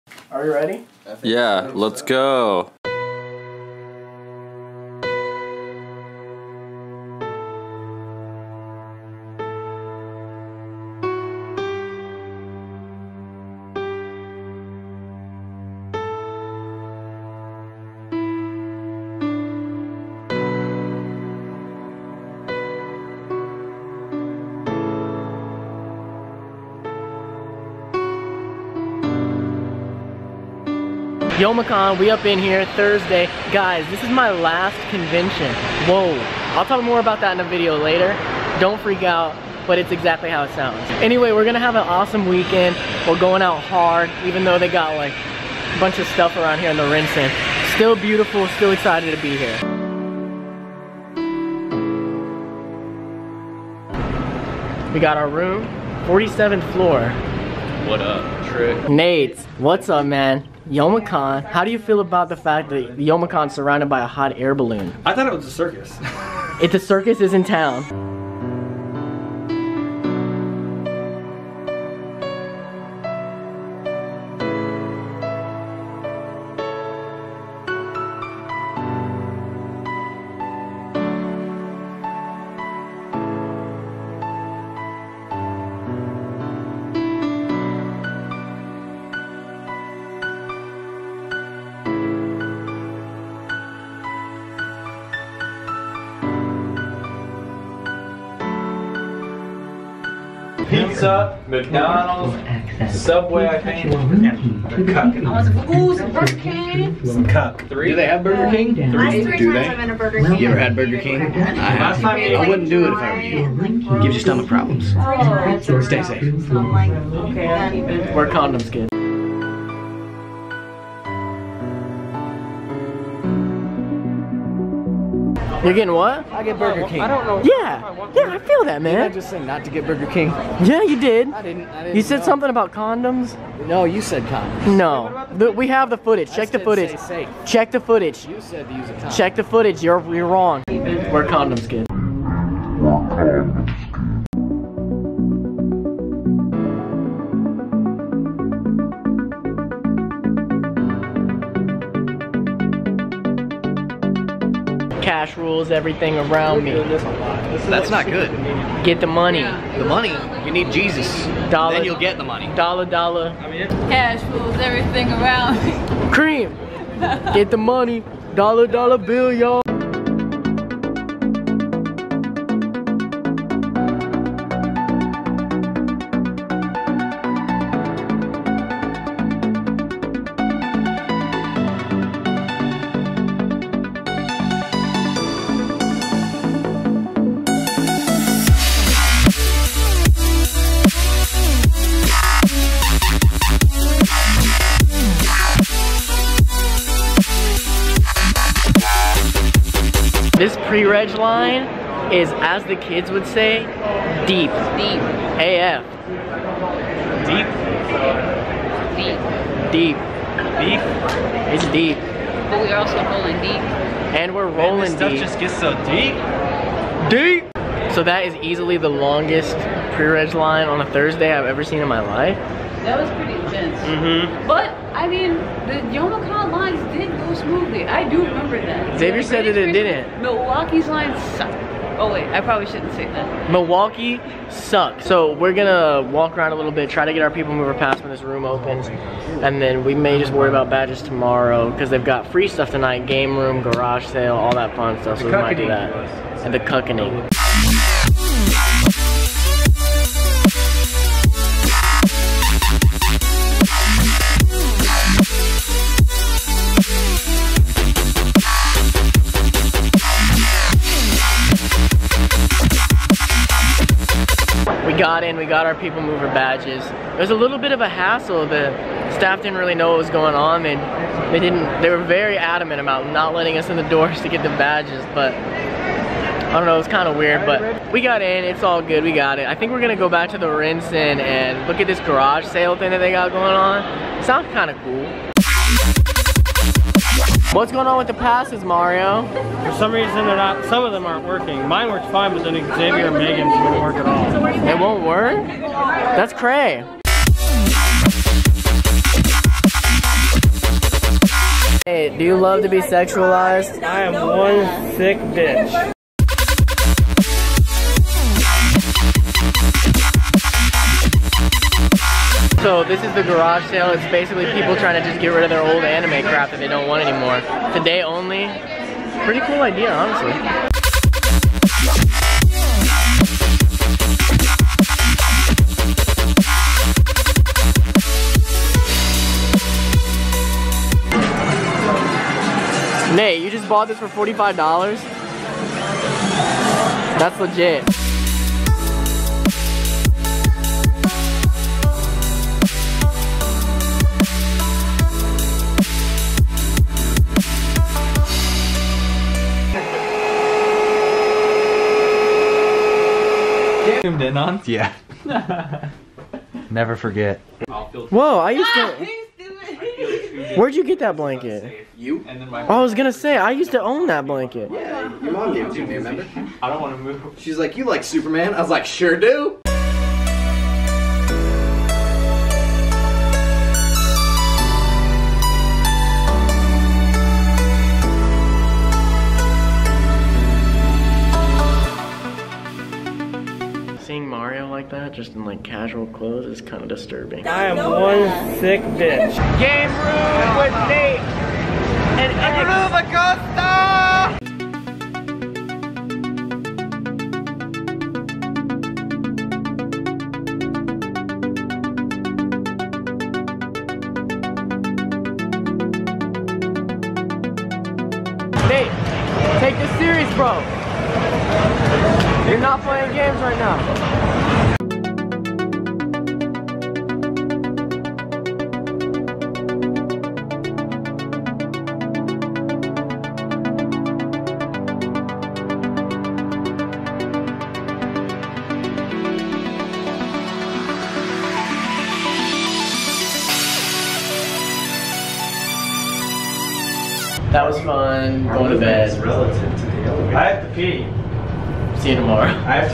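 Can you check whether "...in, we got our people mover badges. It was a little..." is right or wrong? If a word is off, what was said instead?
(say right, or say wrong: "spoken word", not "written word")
right.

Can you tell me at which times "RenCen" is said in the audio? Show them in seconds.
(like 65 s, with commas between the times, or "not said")
46 s, 280 s.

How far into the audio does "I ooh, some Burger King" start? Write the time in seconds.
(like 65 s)
105 s.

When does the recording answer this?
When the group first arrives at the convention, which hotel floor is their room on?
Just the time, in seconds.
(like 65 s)
56 s.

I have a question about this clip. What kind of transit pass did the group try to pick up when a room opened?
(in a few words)
People mover pass.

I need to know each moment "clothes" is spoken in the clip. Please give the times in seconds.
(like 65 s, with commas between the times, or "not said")
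386 s.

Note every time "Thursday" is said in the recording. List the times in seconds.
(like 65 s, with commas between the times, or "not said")
32 s, 220 s.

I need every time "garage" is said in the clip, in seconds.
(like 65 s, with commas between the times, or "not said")
243 s, 282 s, 313 s.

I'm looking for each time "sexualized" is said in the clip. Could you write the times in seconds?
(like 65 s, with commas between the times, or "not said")
302 s.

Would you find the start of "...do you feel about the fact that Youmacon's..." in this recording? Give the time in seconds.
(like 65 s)
61 s.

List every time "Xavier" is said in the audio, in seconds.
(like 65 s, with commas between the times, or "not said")
228 s, 292 s.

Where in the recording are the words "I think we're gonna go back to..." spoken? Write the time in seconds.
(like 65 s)
279 s.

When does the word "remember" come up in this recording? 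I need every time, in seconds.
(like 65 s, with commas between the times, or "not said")
228 s, 365 s.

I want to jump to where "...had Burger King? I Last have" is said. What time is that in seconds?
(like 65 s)
110 s.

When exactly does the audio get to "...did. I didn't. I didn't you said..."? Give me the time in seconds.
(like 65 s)
130 s.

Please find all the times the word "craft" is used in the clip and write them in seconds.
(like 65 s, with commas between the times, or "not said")
not said.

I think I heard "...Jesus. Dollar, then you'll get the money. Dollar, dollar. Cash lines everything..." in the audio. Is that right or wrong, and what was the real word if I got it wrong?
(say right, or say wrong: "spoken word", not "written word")
wrong: "rules", not "lines".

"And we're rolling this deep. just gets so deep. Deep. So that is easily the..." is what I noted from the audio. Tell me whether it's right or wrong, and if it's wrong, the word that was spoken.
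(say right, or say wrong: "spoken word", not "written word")
right.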